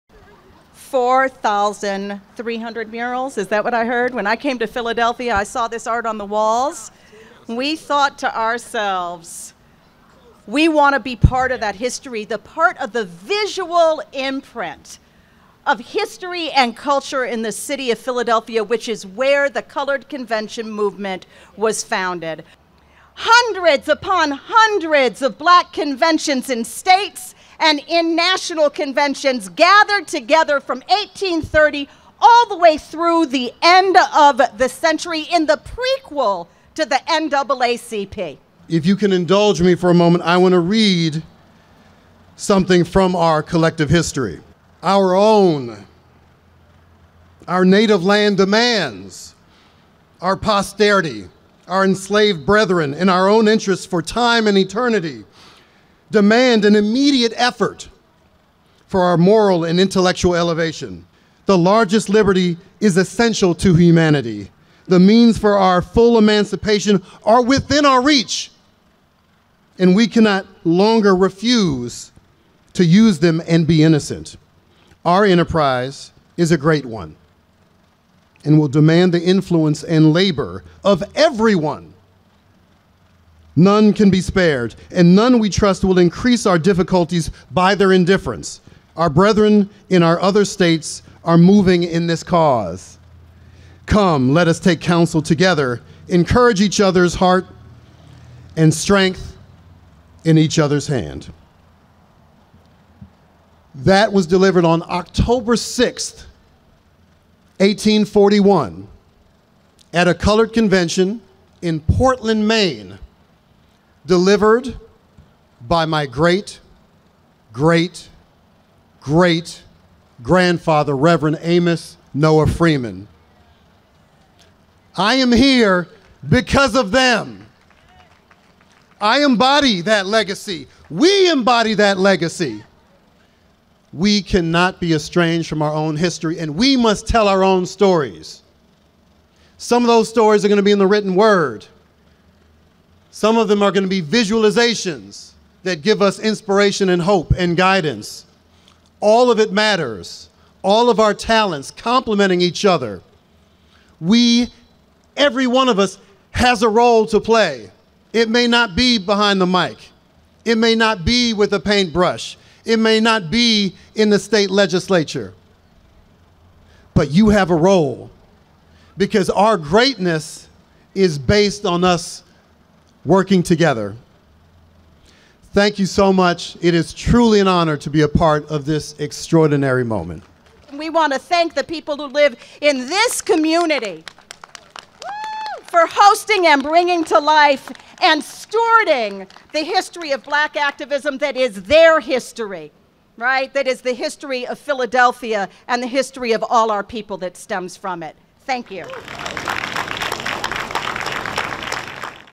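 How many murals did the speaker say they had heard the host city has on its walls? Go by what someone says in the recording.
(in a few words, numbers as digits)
4,300.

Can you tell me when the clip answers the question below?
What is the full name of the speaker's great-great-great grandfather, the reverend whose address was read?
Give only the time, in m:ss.
2:01.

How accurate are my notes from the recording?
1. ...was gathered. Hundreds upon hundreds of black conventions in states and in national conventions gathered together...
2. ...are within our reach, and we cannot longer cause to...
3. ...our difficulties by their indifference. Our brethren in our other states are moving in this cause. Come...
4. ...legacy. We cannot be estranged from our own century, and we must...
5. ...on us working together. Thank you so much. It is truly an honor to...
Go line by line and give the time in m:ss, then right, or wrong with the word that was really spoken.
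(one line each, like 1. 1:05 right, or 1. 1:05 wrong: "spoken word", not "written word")
1. 0:21 wrong: "founded", not "gathered"
2. 1:07 wrong: "refuse", not "cause"
3. 1:26 right
4. 2:11 wrong: "history", not "century"
5. 2:51 right.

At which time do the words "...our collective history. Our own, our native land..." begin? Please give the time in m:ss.
0:43.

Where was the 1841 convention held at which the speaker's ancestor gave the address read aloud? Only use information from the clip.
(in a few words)
Portland, Maine.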